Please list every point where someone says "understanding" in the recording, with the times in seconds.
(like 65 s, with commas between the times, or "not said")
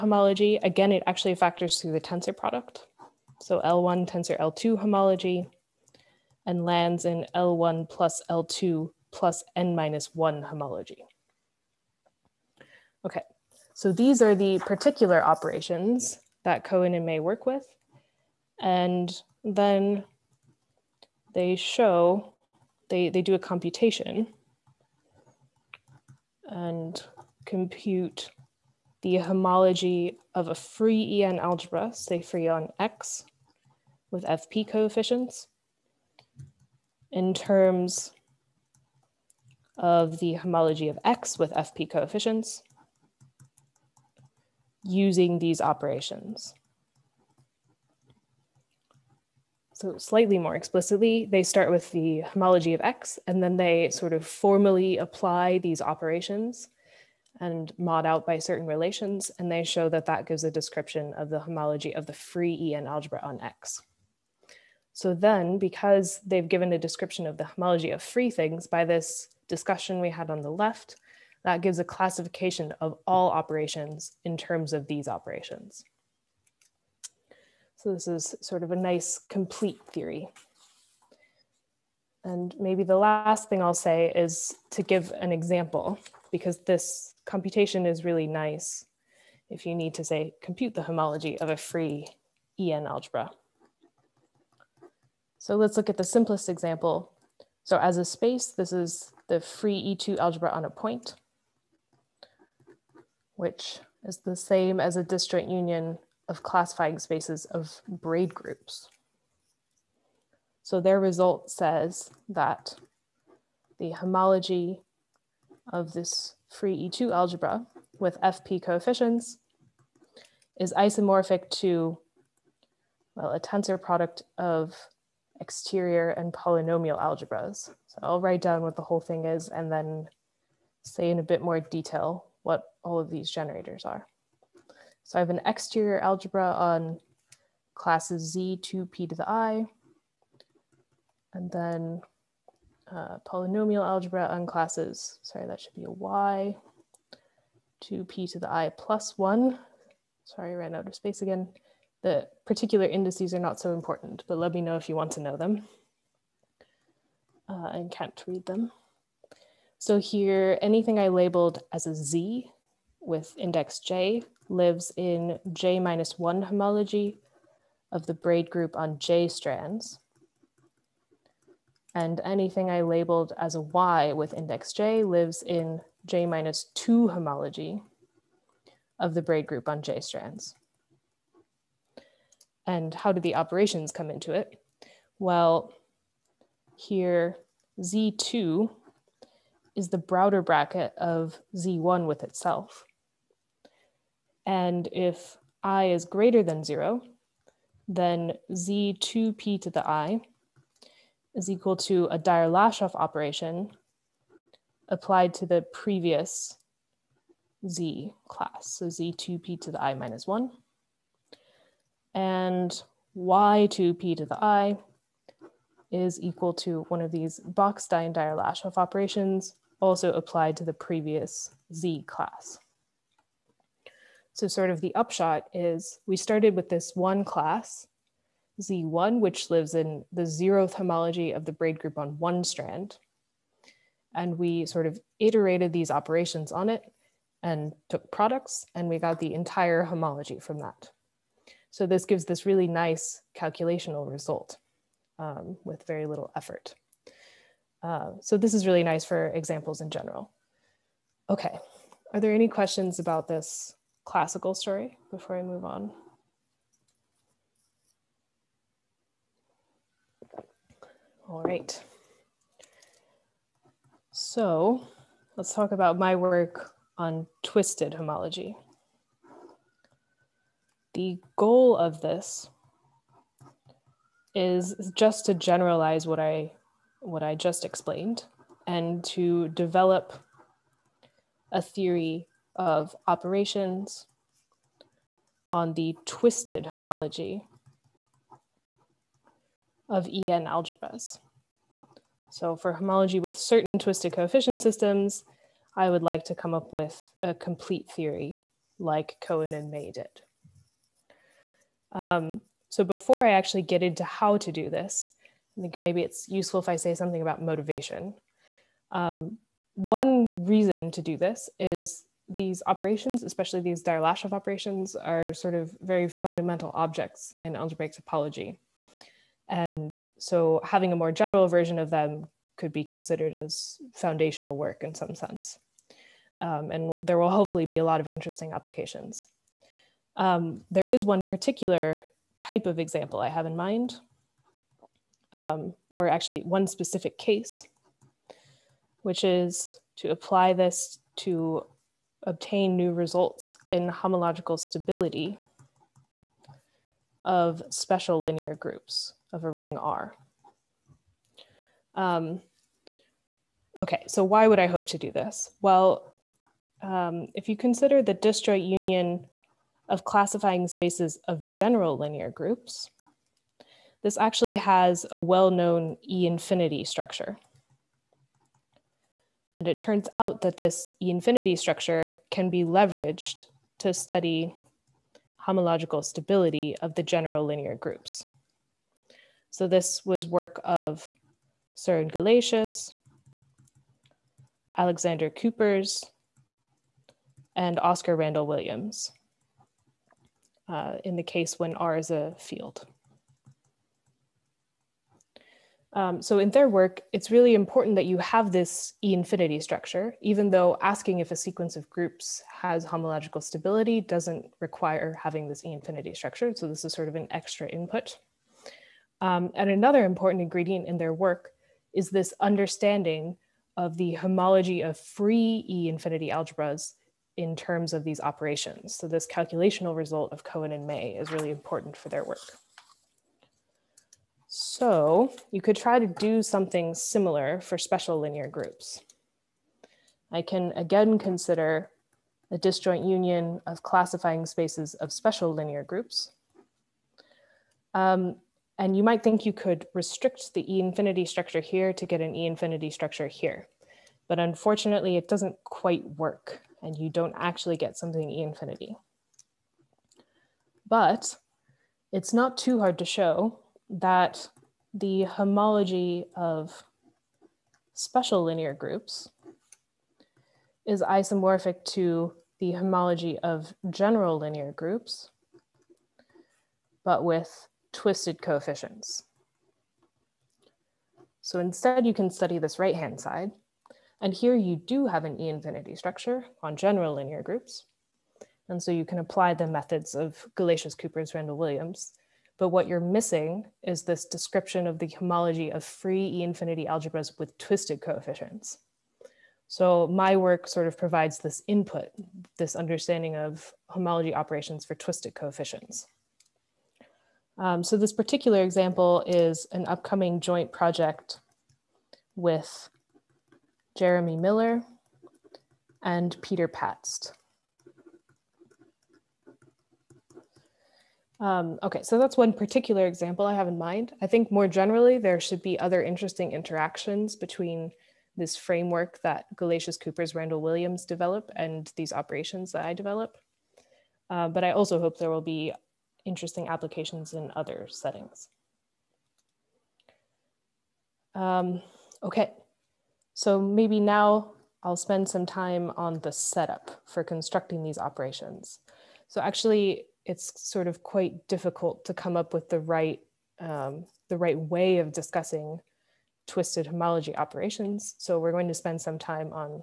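412 s, 492 s.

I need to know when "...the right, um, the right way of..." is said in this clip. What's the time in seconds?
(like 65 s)
542 s.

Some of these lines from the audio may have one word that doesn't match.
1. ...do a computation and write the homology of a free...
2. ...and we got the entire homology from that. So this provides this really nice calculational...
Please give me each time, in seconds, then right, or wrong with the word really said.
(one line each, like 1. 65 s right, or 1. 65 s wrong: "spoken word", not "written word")
1. 23 s wrong: "compute", not "write"
2. 238 s wrong: "gives", not "provides".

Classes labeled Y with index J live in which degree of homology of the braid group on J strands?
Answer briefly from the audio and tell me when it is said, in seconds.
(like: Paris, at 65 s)
J minus 2, at 176 s.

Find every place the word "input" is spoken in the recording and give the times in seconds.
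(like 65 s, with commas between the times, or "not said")
407 s, 491 s.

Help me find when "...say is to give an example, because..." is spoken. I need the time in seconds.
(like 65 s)
83 s.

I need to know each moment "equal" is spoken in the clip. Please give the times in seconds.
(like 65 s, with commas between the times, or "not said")
201 s, 216 s.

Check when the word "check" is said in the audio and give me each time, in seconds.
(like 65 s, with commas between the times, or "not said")
not said.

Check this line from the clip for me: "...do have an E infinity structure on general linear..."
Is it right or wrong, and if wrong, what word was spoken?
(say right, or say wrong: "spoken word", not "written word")
right.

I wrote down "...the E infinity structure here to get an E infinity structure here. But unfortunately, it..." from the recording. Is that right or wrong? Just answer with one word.
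right.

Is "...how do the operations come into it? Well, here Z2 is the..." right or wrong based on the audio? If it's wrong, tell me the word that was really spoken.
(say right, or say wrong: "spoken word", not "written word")
right.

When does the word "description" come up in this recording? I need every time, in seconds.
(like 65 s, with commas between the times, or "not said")
60 s, 66 s, 484 s.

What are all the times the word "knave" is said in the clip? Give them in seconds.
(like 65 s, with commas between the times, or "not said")
not said.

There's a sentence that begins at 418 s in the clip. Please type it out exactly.
So this calculational result of Cohen and May is really important for their work.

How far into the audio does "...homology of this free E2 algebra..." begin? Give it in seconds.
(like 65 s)
113 s.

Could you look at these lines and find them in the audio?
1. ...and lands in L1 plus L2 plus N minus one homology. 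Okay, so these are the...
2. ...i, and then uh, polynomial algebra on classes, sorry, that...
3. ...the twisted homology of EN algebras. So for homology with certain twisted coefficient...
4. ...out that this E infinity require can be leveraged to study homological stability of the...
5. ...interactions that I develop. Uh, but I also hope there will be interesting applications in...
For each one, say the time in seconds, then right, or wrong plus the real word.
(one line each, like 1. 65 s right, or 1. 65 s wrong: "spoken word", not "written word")
1. 6 s right
2. 139 s right
3. 285 s right
4. 370 s wrong: "structure", not "require"
5. 522 s wrong: "operations", not "interactions".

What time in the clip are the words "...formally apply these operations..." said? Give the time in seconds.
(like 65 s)
54 s.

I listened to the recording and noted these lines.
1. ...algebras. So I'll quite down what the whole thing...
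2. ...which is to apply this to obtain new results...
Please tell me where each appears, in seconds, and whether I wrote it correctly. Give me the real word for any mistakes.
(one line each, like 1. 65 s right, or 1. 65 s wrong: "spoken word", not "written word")
1. 127 s wrong: "write", not "quite"
2. 339 s right.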